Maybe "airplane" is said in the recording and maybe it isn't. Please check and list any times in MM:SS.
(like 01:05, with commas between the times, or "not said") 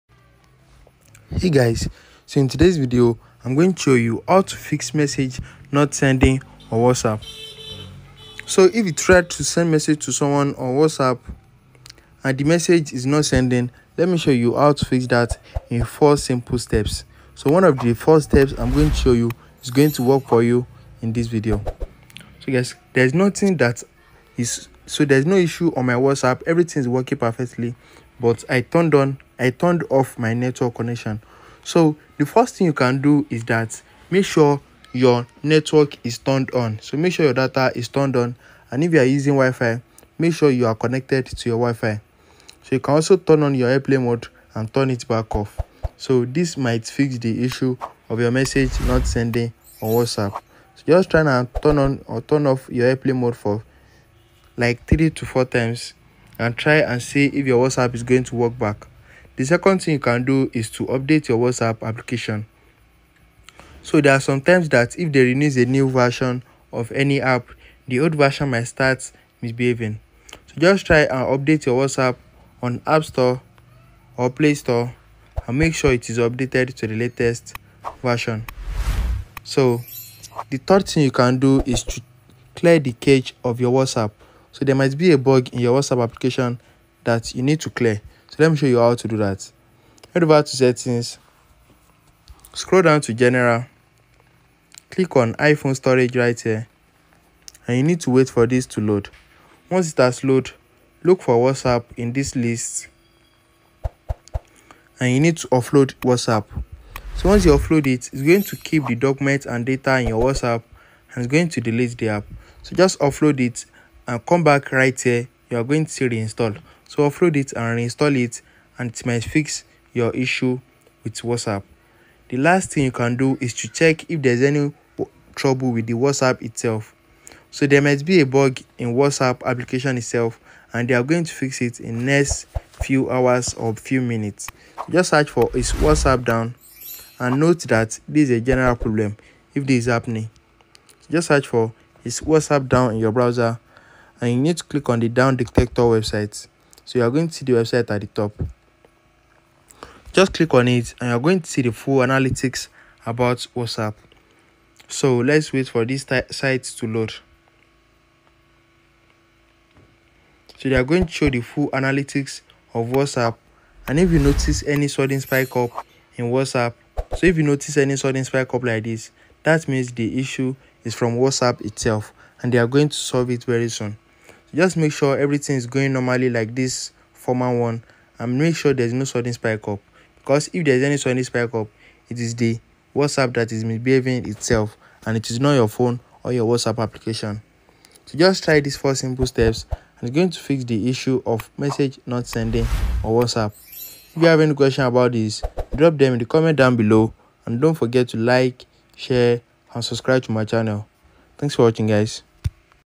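00:43, 00:52.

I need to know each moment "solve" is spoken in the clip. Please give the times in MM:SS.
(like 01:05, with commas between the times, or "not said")
02:52.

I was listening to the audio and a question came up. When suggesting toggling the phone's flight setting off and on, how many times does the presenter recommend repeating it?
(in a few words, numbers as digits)
3 to 4.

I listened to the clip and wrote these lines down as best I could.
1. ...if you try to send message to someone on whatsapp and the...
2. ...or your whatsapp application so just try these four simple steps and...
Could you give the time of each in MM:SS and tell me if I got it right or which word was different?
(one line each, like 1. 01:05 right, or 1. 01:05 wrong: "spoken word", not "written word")
1. 00:08 right
2. 03:06 right.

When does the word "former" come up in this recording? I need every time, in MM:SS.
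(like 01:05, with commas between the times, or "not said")
02:57.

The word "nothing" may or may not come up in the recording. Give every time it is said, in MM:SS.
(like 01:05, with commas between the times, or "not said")
00:23.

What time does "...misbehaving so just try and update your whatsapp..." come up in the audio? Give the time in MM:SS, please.
01:09.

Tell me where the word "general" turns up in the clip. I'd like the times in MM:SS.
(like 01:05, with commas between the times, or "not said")
01:33, 02:18.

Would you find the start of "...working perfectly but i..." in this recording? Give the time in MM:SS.
00:26.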